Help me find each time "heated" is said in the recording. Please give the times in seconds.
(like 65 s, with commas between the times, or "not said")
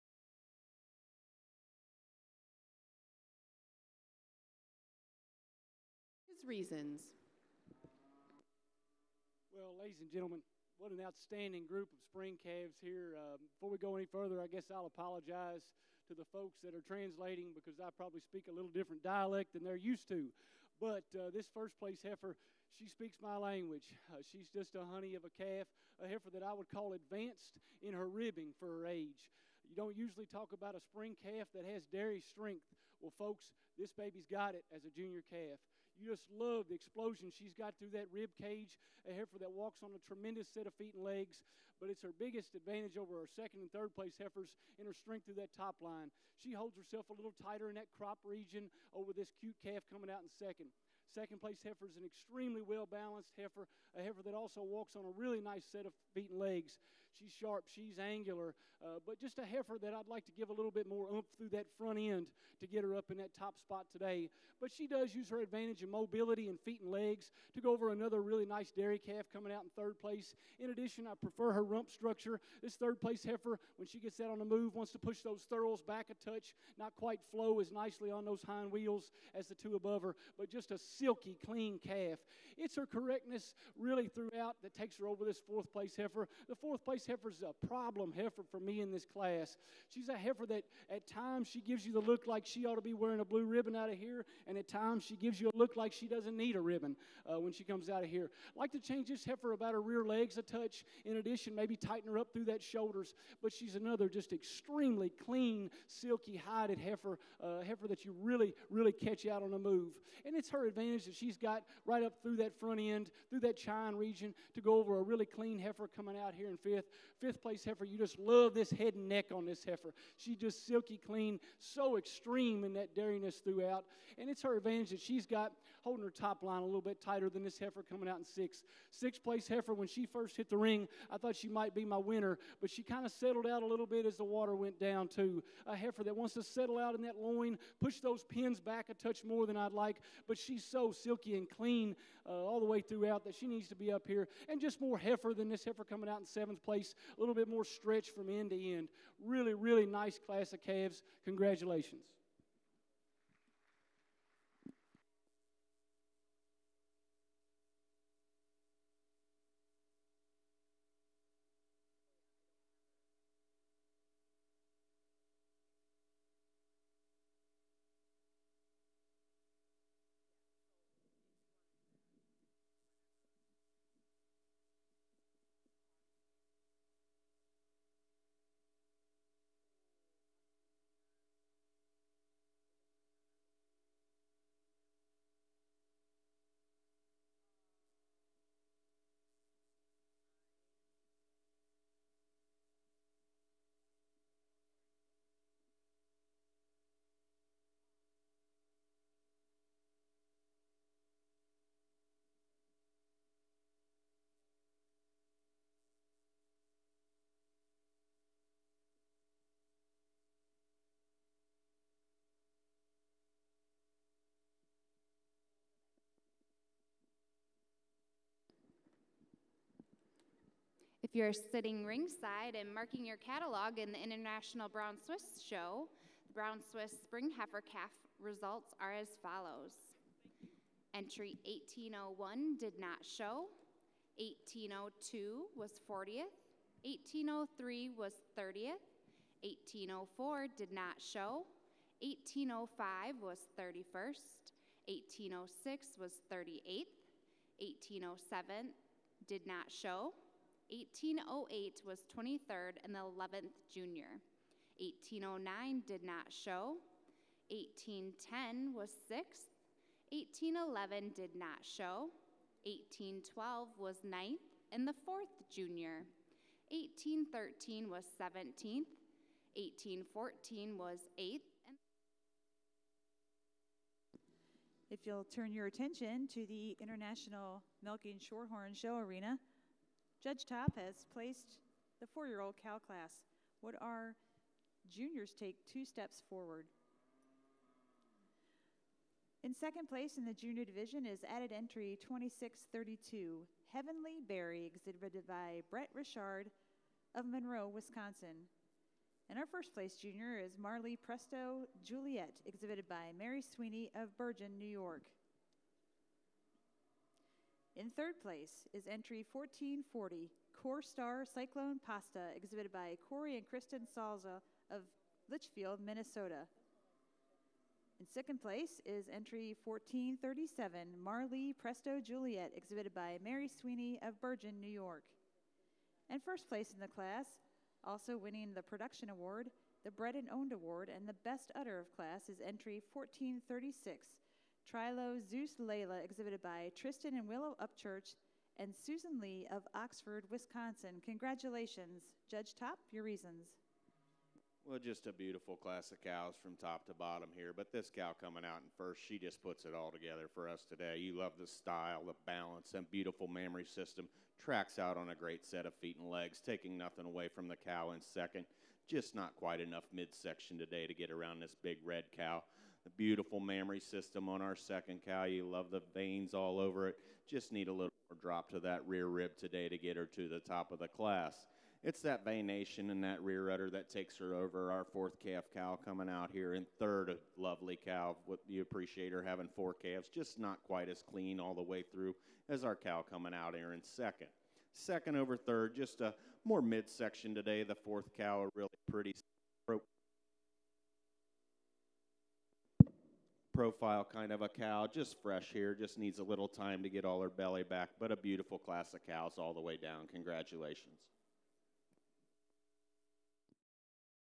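not said.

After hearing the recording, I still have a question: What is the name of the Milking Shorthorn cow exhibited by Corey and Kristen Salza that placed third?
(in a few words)
Core Star Cyclone Pasta.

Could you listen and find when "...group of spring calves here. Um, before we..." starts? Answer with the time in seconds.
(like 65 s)
11 s.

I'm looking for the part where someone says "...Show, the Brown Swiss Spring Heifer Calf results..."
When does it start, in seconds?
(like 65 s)
225 s.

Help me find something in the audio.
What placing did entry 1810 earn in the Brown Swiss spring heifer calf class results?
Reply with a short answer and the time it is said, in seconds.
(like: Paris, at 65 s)
6th, at 257 s.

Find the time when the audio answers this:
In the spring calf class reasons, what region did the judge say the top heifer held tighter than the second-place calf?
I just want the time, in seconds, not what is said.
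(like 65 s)
47 s.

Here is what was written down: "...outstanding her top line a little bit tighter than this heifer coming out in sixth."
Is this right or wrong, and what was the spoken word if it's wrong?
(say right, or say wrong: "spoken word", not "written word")
wrong: "holding", not "outstanding".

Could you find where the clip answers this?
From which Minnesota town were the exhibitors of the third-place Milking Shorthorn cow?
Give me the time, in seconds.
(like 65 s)
315 s.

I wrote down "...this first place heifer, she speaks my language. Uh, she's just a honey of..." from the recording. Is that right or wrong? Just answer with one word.
right.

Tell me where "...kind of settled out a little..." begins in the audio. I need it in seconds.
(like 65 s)
132 s.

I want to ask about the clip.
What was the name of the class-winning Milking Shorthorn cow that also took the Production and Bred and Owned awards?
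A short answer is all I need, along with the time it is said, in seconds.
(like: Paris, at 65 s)
Trilo Zeus Layla, at 334 s.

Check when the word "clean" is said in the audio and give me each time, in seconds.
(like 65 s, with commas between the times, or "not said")
81 s, 105 s, 115 s, 121 s, 141 s, 381 s.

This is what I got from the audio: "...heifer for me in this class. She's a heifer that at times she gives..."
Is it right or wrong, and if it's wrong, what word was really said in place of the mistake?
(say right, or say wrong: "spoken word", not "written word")
right.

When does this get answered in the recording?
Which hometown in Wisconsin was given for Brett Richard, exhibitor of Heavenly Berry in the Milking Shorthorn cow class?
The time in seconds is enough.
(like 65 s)
297 s.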